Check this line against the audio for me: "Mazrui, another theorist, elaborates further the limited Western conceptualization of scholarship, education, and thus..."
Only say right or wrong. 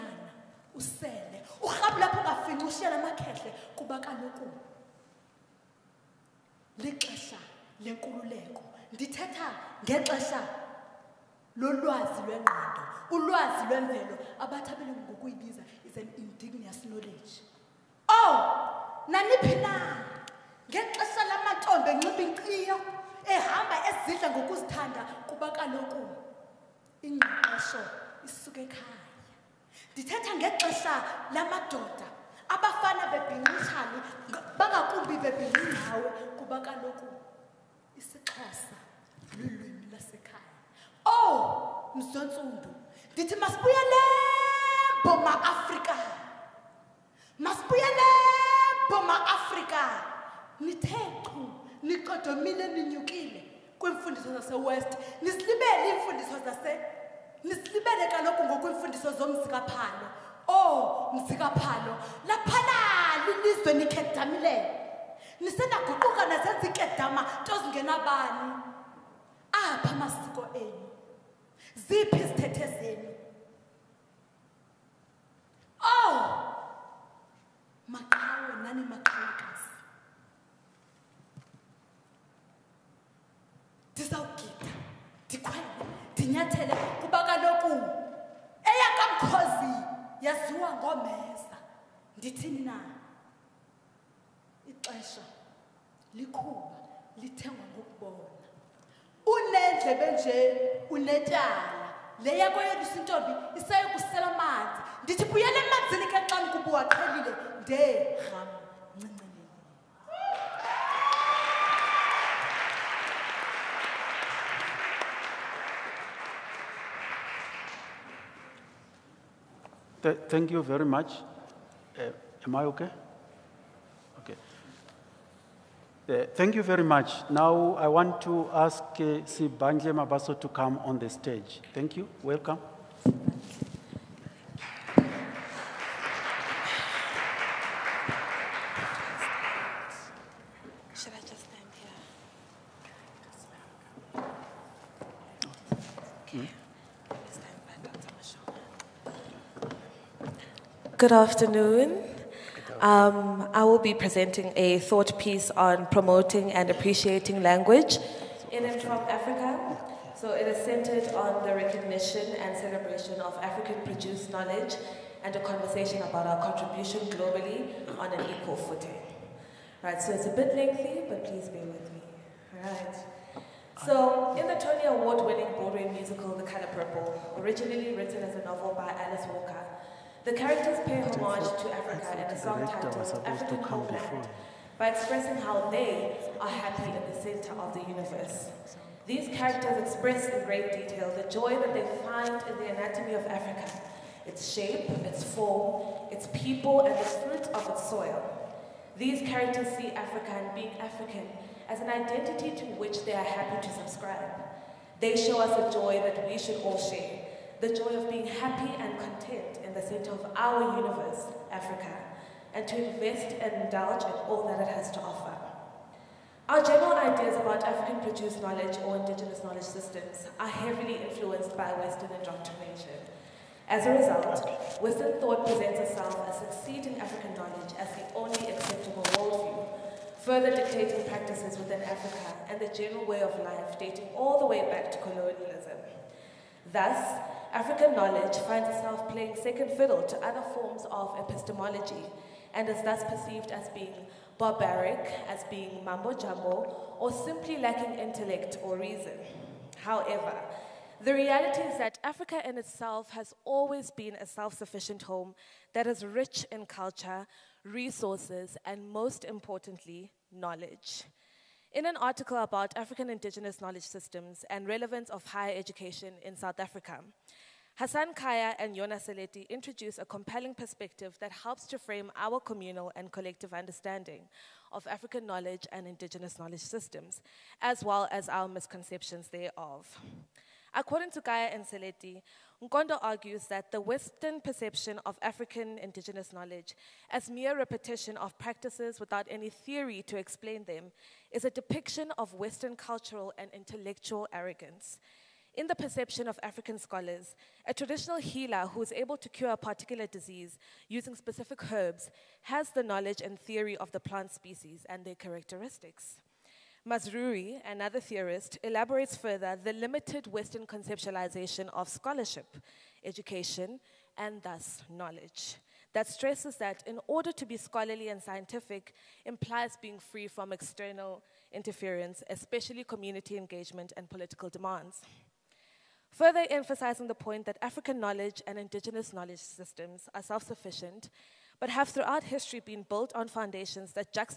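right.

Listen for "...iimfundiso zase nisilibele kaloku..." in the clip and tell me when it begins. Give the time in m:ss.
0:55.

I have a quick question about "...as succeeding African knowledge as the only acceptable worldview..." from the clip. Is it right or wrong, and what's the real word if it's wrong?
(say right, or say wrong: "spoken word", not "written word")
right.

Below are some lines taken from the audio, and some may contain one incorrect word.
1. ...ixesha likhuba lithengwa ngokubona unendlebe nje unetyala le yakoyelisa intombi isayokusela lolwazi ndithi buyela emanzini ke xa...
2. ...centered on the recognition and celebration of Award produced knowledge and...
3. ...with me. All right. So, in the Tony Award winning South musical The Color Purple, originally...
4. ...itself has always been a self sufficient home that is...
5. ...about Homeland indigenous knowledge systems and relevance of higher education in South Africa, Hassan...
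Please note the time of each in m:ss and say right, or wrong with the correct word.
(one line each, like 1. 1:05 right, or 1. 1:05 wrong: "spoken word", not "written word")
1. 1:34 wrong: "amanzi", not "lolwazi"
2. 2:40 wrong: "African", not "Award"
3. 2:51 wrong: "Broadway", not "South"
4. 4:12 right
5. 4:22 wrong: "African", not "Homeland".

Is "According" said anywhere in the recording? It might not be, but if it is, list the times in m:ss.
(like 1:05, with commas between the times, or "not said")
4:40.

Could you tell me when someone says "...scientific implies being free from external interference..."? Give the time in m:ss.
5:18.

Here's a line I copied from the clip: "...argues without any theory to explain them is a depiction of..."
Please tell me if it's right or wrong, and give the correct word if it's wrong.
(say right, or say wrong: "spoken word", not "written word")
wrong: "practices", not "argues".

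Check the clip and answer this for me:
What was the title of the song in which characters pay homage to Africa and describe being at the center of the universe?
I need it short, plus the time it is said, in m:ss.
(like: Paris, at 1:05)
African Homeland, at 3:03.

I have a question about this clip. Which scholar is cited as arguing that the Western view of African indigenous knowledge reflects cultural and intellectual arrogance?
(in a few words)
Nkondo.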